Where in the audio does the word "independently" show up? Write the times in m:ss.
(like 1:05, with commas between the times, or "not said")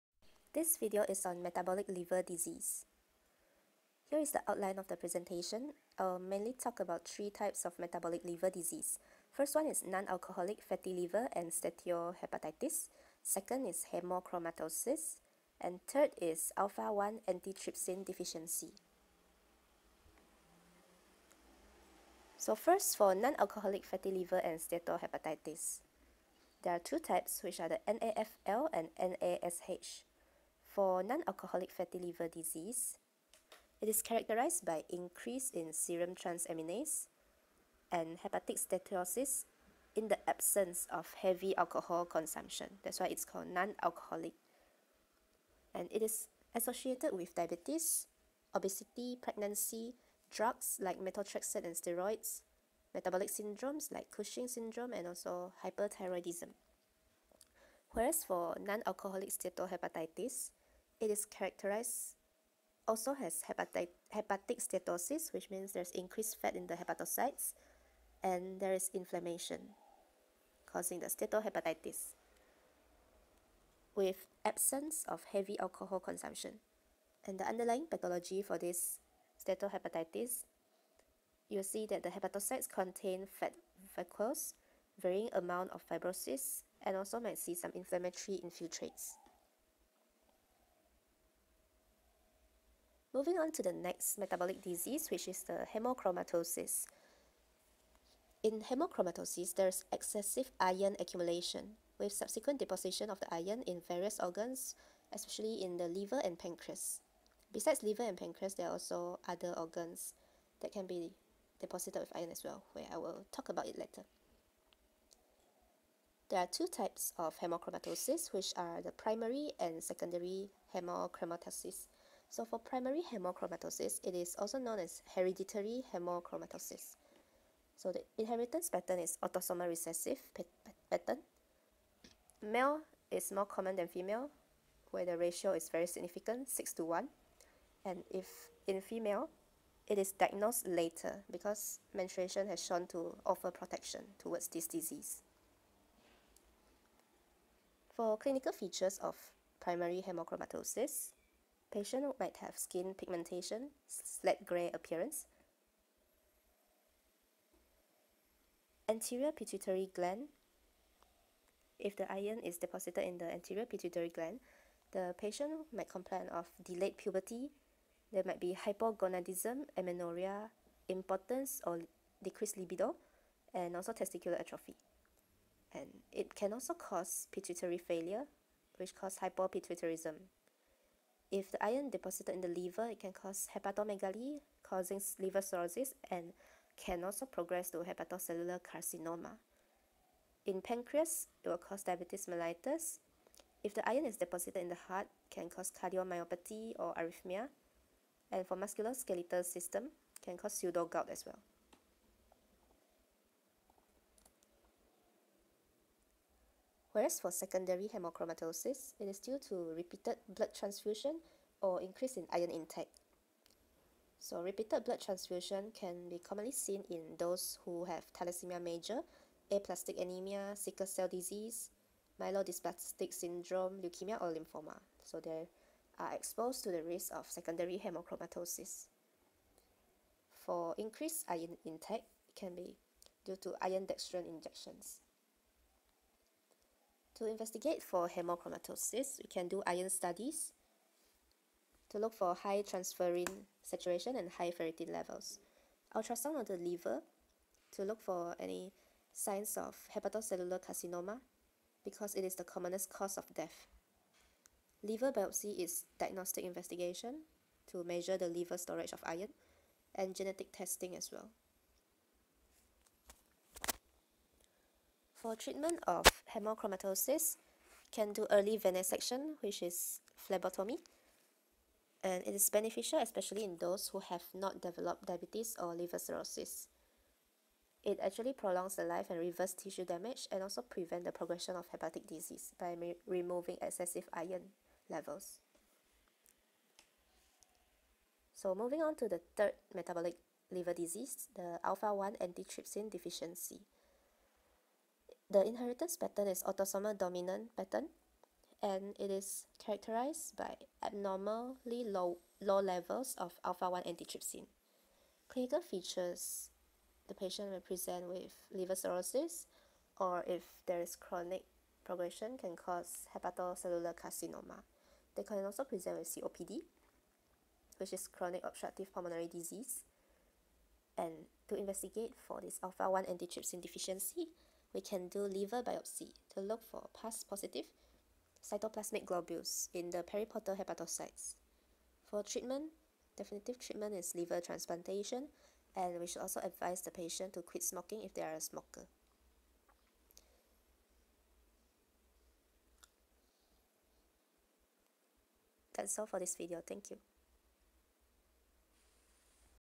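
not said.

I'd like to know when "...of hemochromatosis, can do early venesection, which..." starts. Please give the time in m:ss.
4:25.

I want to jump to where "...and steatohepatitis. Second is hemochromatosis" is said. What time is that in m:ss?
0:11.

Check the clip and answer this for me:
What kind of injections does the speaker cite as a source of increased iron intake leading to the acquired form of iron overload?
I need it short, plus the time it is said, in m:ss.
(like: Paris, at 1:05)
iron dextran injections, at 3:53.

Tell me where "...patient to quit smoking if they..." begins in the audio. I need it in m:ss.
5:36.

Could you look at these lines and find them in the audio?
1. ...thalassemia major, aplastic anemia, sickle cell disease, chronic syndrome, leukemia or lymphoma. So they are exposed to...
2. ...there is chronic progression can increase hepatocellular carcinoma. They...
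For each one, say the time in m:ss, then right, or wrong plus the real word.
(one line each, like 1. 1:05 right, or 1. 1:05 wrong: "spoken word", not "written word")
1. 3:38 wrong: "myelodysplastic", not "chronic"
2. 5:10 wrong: "cause", not "increase".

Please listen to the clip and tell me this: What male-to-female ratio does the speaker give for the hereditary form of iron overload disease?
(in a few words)
6 to 1.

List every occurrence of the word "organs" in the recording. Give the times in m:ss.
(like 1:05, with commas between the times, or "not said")
1:44, 1:49.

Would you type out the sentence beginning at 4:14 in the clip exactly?
Liver biopsy is diagnostic investigation to measure the liver storage of iron and genetic testing as well.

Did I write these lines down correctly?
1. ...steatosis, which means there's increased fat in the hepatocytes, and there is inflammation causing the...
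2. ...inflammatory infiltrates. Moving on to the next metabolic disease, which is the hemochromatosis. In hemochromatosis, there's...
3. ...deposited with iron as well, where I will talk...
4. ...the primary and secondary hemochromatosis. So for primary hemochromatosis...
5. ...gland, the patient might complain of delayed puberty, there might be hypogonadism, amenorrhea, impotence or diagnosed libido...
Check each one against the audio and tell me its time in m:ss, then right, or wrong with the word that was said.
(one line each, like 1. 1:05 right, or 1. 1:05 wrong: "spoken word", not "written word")
1. 1:04 right
2. 1:27 right
3. 1:51 right
4. 1:58 right
5. 2:44 wrong: "decreased", not "diagnosed".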